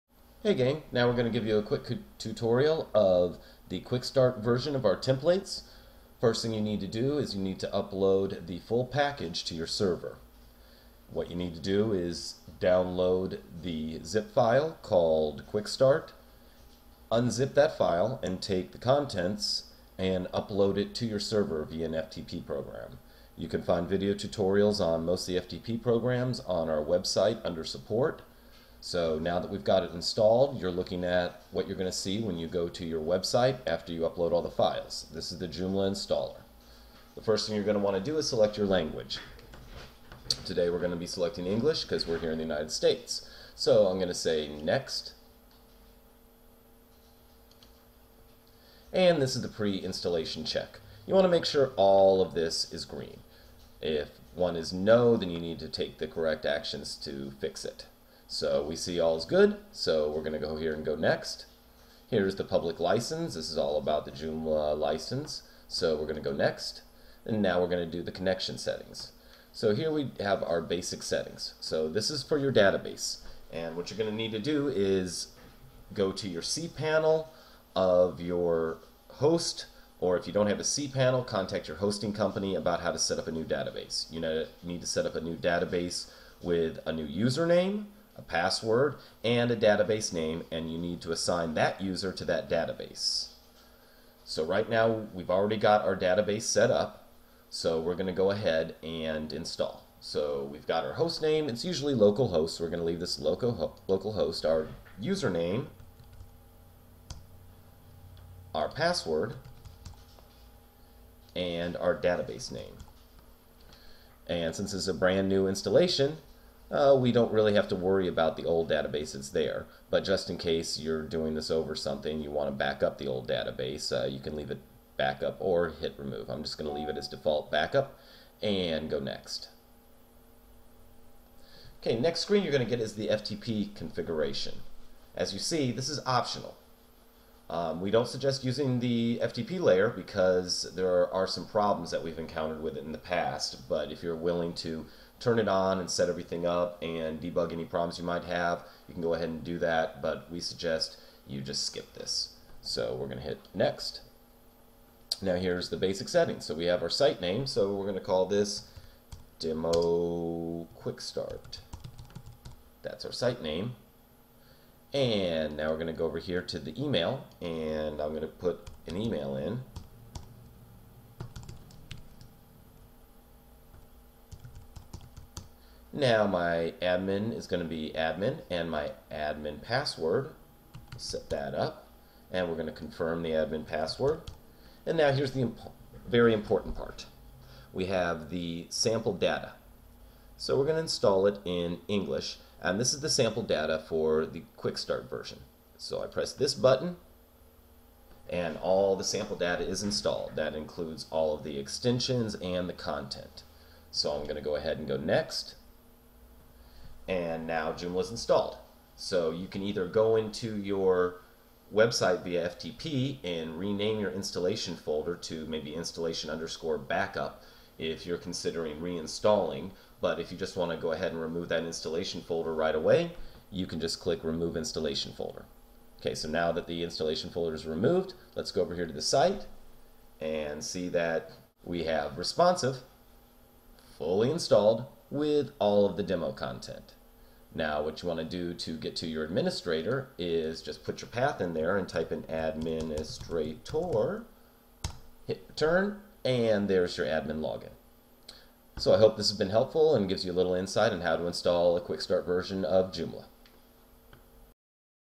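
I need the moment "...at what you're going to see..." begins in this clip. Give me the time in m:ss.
0:31.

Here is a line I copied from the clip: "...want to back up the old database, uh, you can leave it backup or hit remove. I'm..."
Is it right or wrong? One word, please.
right.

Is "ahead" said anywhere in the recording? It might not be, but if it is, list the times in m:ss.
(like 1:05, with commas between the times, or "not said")
1:38, 2:29, 3:24, 3:40.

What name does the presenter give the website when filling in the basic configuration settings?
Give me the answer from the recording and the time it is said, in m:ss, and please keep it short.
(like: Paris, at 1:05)
Demo Quick Start, at 2:39.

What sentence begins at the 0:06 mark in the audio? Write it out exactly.
First thing you need to do is you need to upload the full package to your server.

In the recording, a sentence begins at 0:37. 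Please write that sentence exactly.
The first thing you're going to want to do is select your language.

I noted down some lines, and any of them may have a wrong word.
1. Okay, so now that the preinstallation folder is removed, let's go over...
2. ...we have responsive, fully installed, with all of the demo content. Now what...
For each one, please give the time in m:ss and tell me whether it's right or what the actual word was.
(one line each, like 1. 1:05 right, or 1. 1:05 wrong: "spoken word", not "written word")
1. 3:45 wrong: "installation", not "preinstallation"
2. 3:51 right.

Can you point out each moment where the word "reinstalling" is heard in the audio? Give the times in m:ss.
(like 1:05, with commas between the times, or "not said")
3:38.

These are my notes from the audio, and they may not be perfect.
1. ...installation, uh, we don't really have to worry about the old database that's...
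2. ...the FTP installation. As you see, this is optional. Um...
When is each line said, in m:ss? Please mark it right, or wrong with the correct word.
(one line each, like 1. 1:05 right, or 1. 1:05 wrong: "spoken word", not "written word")
1. 1:55 right
2. 2:12 wrong: "configuration", not "installation".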